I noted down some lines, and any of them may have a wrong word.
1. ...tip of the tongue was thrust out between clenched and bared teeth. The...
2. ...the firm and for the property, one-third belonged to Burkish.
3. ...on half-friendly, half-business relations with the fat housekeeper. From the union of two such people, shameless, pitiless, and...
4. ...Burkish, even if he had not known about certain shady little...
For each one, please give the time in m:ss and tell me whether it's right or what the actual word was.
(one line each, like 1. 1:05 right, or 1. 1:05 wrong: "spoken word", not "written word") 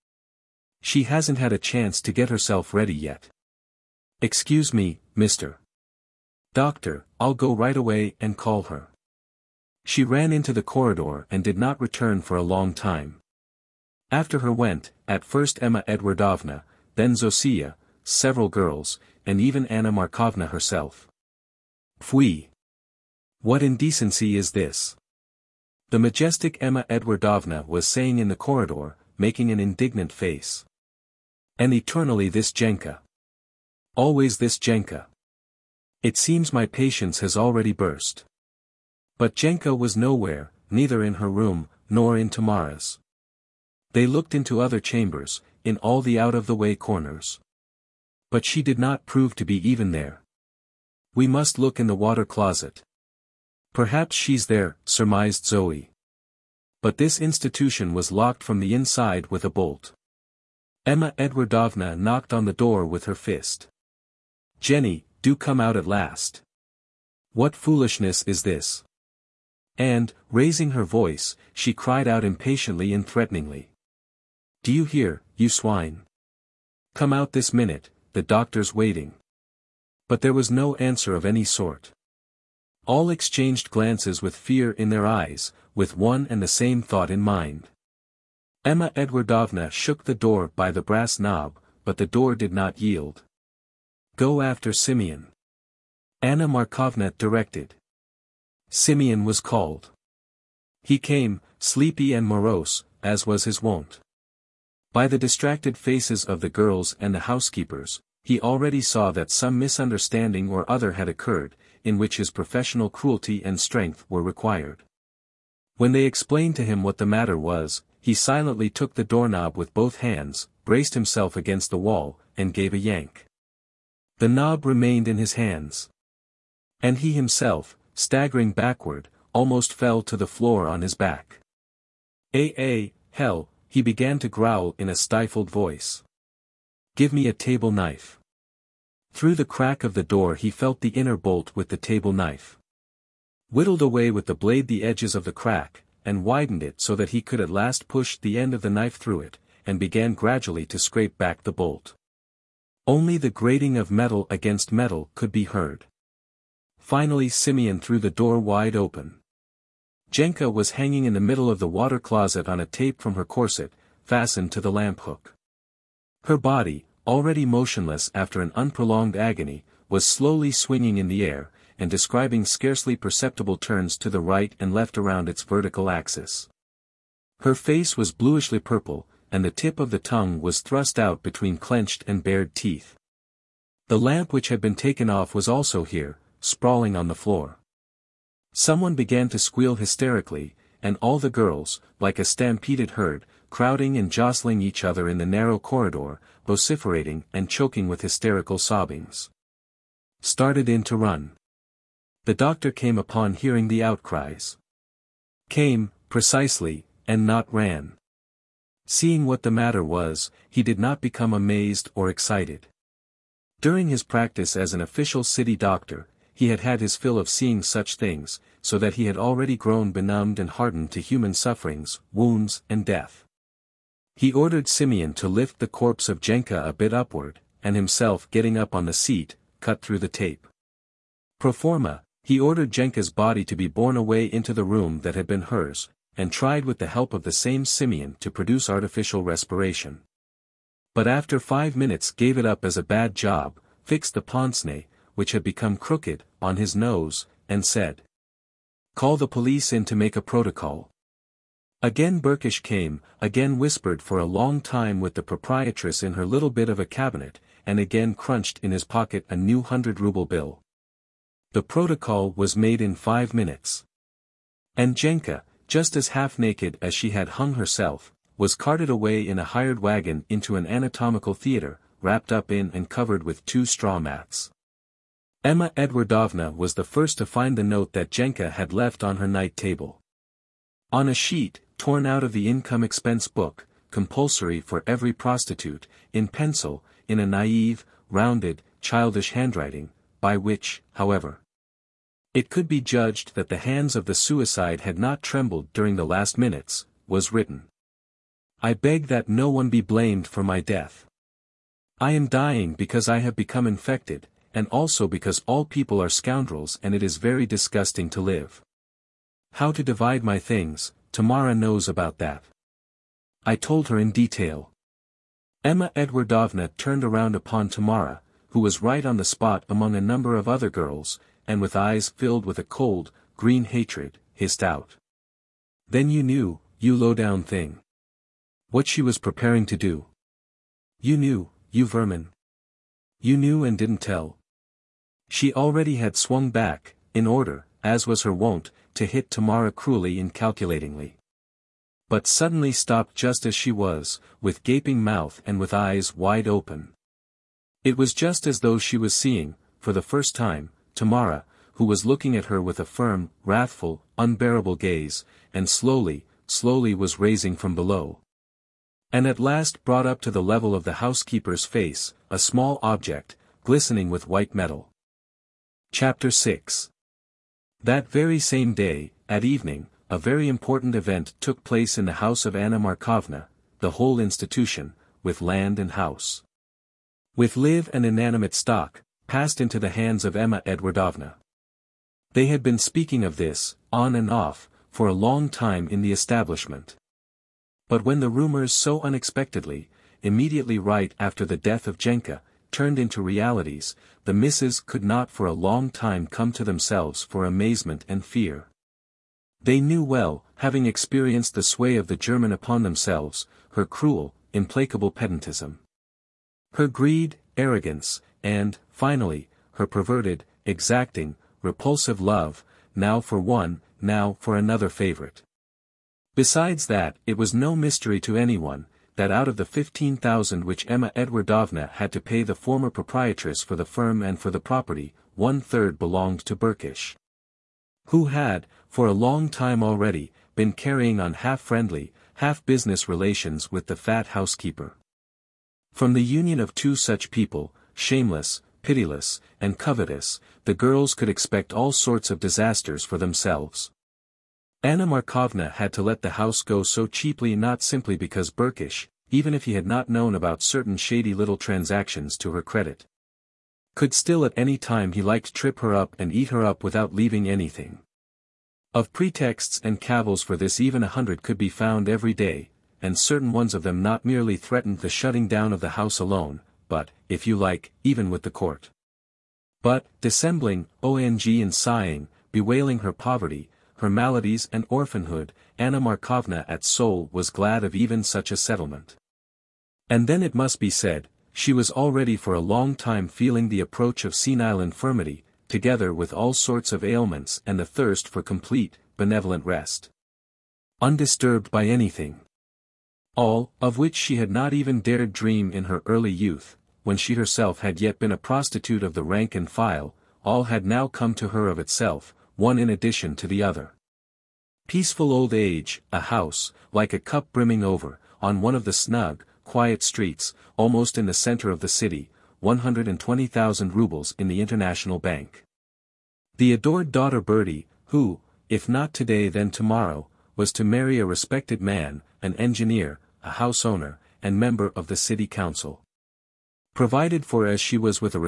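1. 2:59 right
2. 7:03 right
3. 7:11 right
4. 7:28 right.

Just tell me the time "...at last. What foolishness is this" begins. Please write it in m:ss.
1:05.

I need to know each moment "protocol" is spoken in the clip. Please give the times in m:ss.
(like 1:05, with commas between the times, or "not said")
4:10, 4:21.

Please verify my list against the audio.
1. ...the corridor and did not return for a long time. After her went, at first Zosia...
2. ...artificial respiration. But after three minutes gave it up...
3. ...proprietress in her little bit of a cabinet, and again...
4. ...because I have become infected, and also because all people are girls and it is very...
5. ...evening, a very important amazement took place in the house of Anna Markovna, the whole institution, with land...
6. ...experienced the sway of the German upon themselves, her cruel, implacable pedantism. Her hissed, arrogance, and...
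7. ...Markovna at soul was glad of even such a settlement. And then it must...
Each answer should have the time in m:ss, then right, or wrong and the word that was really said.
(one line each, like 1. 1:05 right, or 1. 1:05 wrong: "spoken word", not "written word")
1. 0:10 wrong: "Emma", not "Zosia"
2. 3:58 wrong: "five", not "three"
3. 4:15 right
4. 5:02 wrong: "scoundrels", not "girls"
5. 6:09 wrong: "event", not "amazement"
6. 6:40 wrong: "greed", not "hissed"
7. 7:55 right.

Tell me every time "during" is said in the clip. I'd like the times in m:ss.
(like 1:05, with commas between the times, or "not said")
3:33, 4:55.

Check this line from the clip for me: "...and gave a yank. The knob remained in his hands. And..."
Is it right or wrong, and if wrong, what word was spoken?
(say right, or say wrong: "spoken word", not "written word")
right.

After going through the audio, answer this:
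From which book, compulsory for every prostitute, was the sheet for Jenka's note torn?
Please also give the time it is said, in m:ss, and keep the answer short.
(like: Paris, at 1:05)
The income expense book, at 4:42.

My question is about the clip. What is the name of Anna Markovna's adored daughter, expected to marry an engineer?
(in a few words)
Bertie.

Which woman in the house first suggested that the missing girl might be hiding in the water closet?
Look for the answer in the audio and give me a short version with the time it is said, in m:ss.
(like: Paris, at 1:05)
Zoe, at 0:55.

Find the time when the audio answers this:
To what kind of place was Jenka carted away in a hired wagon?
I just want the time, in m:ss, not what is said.
4:30.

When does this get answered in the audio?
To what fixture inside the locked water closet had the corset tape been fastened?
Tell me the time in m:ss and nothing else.
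2:44.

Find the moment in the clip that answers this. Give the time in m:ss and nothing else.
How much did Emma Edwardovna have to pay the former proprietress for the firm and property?
6:59.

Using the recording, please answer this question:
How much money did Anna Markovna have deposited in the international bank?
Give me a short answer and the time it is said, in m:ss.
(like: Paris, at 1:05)
120,000 rubles, at 8:32.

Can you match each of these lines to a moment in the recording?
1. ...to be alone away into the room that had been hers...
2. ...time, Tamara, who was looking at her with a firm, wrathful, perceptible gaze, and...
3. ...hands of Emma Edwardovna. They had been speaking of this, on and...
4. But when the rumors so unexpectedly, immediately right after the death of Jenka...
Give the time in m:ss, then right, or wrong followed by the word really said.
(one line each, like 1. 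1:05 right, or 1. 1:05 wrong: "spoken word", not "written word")
1. 3:53 wrong: "borne", not "alone"
2. 5:50 wrong: "unbearable", not "perceptible"
3. 6:19 right
4. 6:27 right.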